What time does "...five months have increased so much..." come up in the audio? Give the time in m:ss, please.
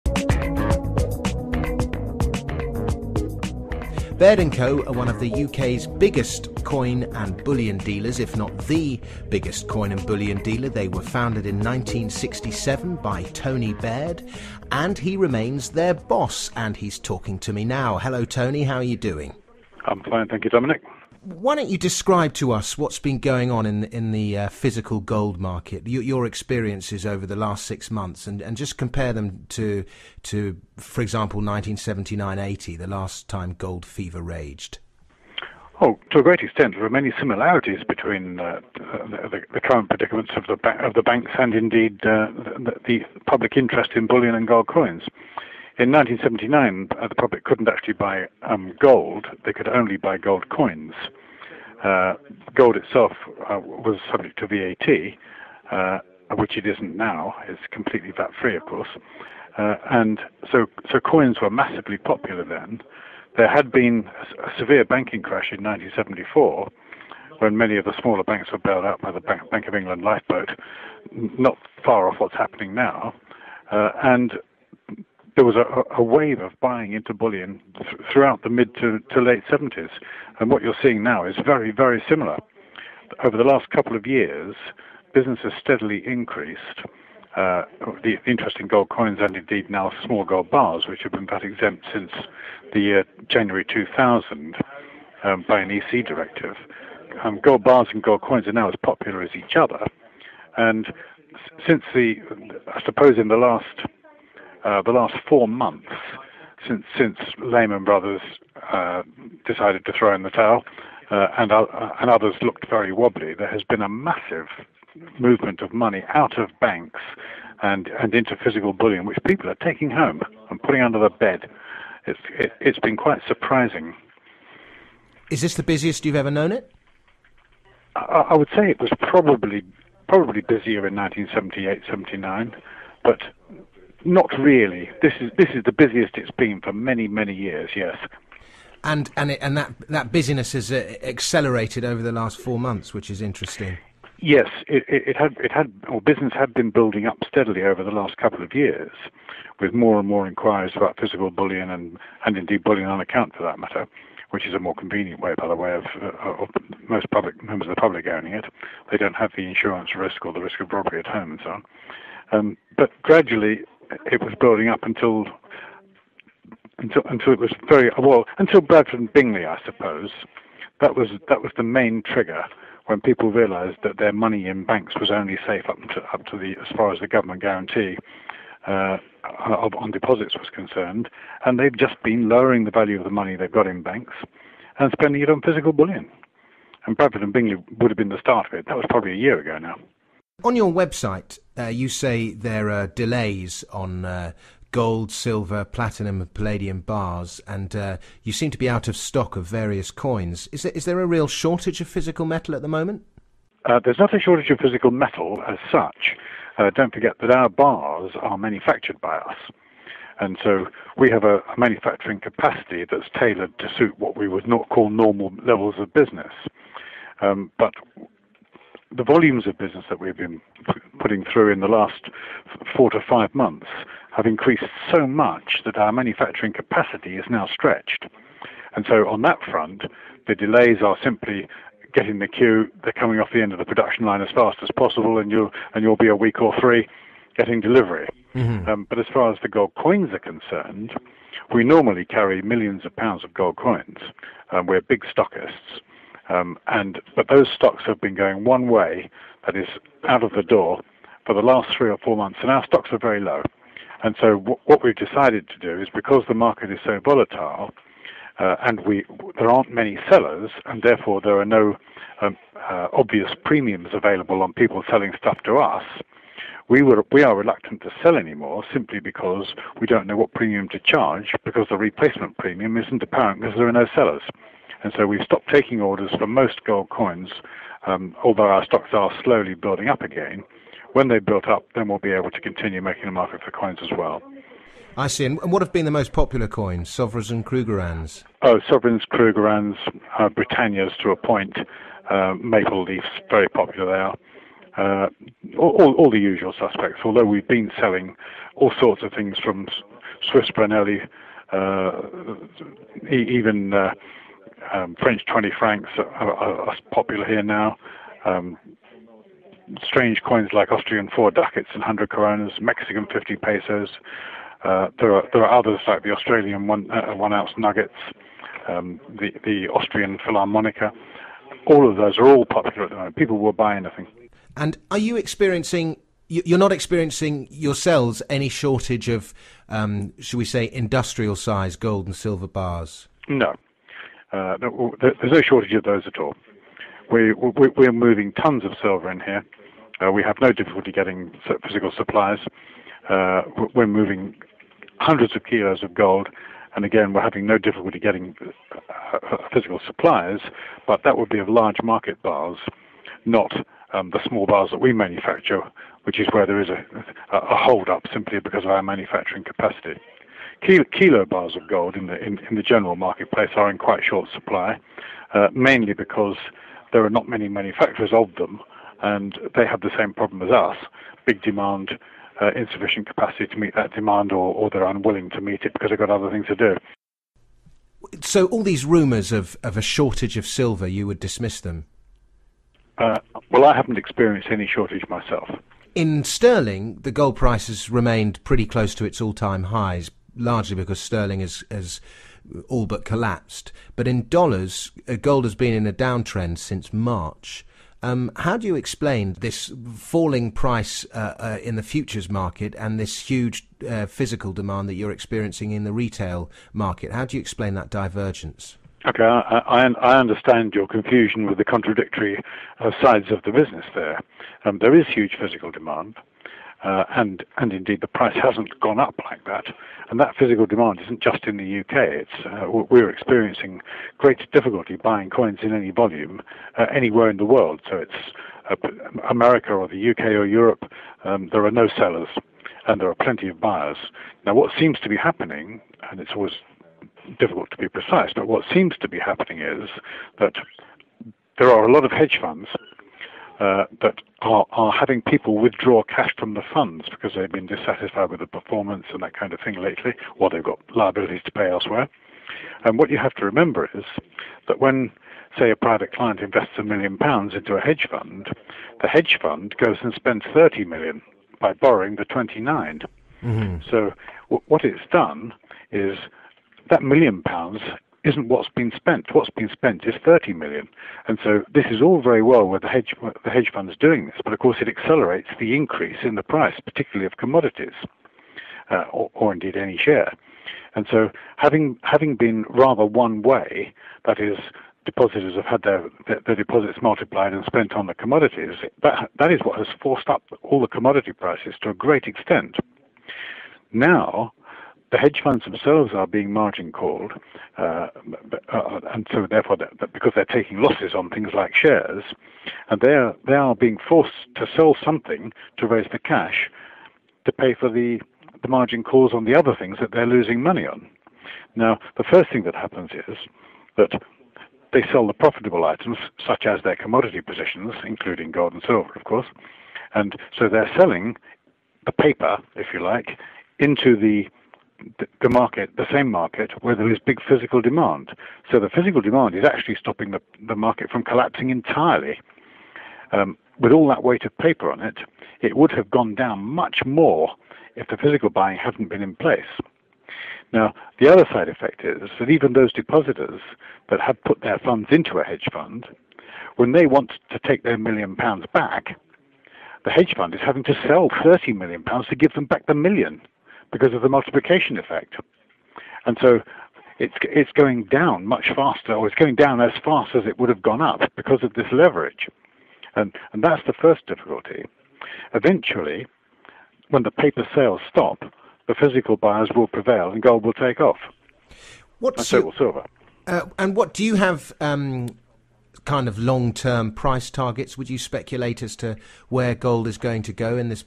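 3:43.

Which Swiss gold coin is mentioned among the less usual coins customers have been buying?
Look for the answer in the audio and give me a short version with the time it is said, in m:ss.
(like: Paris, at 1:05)
Swiss Vreneli, at 5:00.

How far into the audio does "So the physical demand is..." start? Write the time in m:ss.
8:48.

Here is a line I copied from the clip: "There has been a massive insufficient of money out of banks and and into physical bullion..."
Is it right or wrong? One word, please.
wrong.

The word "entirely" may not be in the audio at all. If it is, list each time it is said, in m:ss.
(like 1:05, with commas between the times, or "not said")
8:51.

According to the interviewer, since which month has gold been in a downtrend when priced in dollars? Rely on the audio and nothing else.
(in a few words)
March.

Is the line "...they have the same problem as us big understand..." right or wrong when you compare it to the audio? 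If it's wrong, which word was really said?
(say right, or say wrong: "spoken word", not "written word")
wrong: "demand", not "understand".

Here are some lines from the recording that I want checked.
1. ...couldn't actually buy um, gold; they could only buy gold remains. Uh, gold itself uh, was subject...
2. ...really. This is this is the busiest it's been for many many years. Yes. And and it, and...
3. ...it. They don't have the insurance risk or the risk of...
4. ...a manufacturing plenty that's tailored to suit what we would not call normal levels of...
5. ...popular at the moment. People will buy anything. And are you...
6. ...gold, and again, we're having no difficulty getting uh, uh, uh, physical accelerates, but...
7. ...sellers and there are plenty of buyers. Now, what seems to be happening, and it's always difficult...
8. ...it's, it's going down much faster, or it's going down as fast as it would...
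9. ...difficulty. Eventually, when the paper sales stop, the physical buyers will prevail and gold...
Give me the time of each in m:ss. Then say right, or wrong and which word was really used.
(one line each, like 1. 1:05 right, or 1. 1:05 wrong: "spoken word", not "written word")
1. 0:47 wrong: "coins", not "remains"
2. 2:14 right
3. 2:38 right
4. 3:31 wrong: "capacity", not "plenty"
5. 5:22 right
6. 5:45 wrong: "supplies", not "accelerates"
7. 7:11 right
8. 9:17 right
9. 9:24 right.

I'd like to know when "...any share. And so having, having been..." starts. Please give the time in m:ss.
7:59.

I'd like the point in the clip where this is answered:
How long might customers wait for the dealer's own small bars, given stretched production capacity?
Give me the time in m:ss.
3:56.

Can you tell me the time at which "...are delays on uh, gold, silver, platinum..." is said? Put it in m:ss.
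3:12.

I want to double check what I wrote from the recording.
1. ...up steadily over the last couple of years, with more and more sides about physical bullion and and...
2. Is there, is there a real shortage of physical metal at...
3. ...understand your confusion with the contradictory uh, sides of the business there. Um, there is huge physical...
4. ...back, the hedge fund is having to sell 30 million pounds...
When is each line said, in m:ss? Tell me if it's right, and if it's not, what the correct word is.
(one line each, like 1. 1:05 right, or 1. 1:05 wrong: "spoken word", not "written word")
1. 2:27 wrong: "inquiries", not "sides"
2. 3:20 right
3. 6:50 right
4. 9:08 right.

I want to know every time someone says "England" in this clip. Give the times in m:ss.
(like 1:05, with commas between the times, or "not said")
1:09.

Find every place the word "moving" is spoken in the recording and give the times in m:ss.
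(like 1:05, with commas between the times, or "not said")
5:37, 5:43.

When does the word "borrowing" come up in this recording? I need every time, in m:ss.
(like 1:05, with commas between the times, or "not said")
7:41.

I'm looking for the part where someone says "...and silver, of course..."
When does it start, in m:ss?
8:38.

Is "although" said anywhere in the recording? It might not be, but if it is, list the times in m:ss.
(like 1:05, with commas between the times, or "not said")
4:38, 4:57.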